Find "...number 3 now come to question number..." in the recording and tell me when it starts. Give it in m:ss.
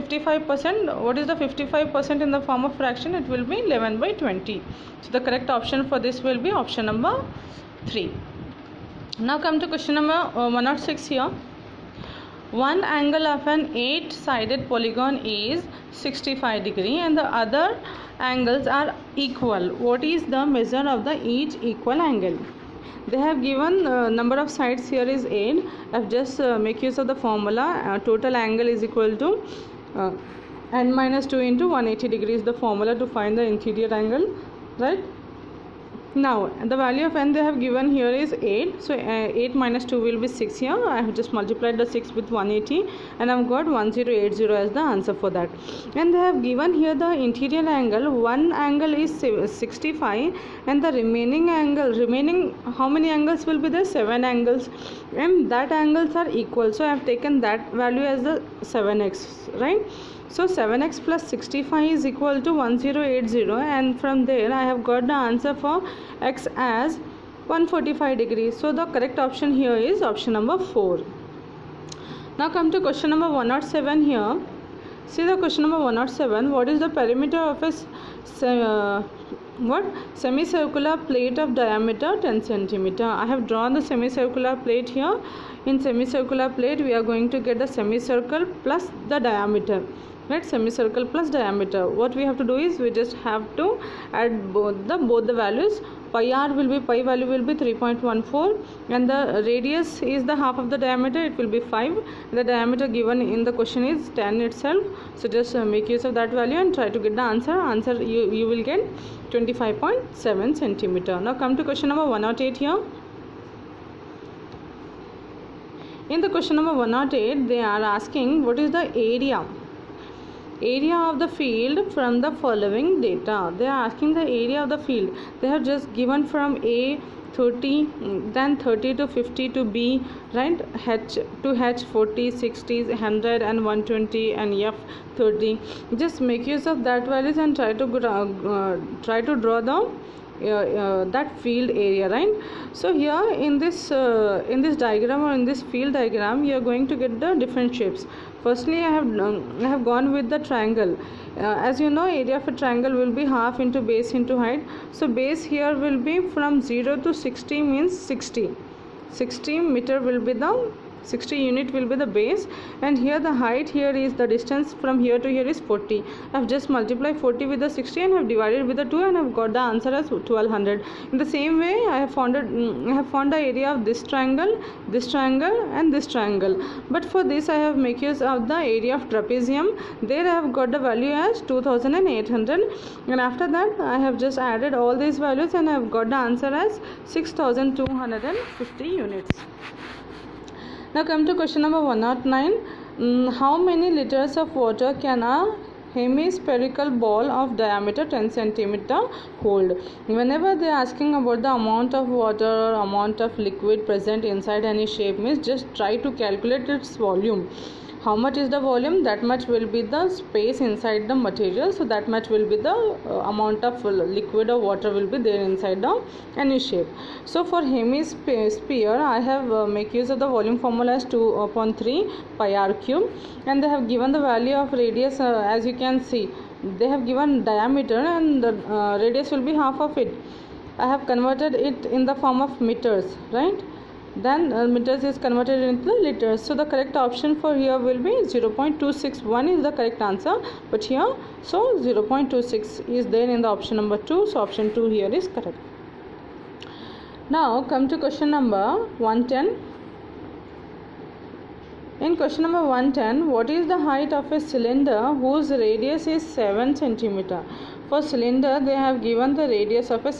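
0:06.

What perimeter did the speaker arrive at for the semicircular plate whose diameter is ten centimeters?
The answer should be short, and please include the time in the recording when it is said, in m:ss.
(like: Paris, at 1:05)
25.7 centimeters, at 1:49.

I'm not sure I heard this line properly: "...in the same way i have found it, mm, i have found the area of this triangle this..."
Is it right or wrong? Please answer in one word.
right.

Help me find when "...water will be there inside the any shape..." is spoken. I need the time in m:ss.
3:34.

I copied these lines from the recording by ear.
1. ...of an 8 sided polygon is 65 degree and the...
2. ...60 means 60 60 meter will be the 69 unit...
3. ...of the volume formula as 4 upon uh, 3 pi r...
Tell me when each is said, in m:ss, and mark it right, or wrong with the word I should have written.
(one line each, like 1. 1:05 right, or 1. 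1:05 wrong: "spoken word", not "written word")
1. 0:13 right
2. 2:37 wrong: "60", not "69"
3. 3:40 wrong: "2", not "4".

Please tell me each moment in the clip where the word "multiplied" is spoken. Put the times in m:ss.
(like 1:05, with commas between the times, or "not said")
0:41, 2:46.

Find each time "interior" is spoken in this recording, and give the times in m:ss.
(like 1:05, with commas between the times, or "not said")
0:33, 0:47.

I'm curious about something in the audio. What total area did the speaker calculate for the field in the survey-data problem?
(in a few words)
6250 units.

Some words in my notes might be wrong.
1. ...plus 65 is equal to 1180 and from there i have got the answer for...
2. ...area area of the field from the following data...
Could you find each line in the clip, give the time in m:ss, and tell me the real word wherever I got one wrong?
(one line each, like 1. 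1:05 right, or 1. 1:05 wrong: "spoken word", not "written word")
1. 1:01 wrong: "1080", not "1180"
2. 1:59 right.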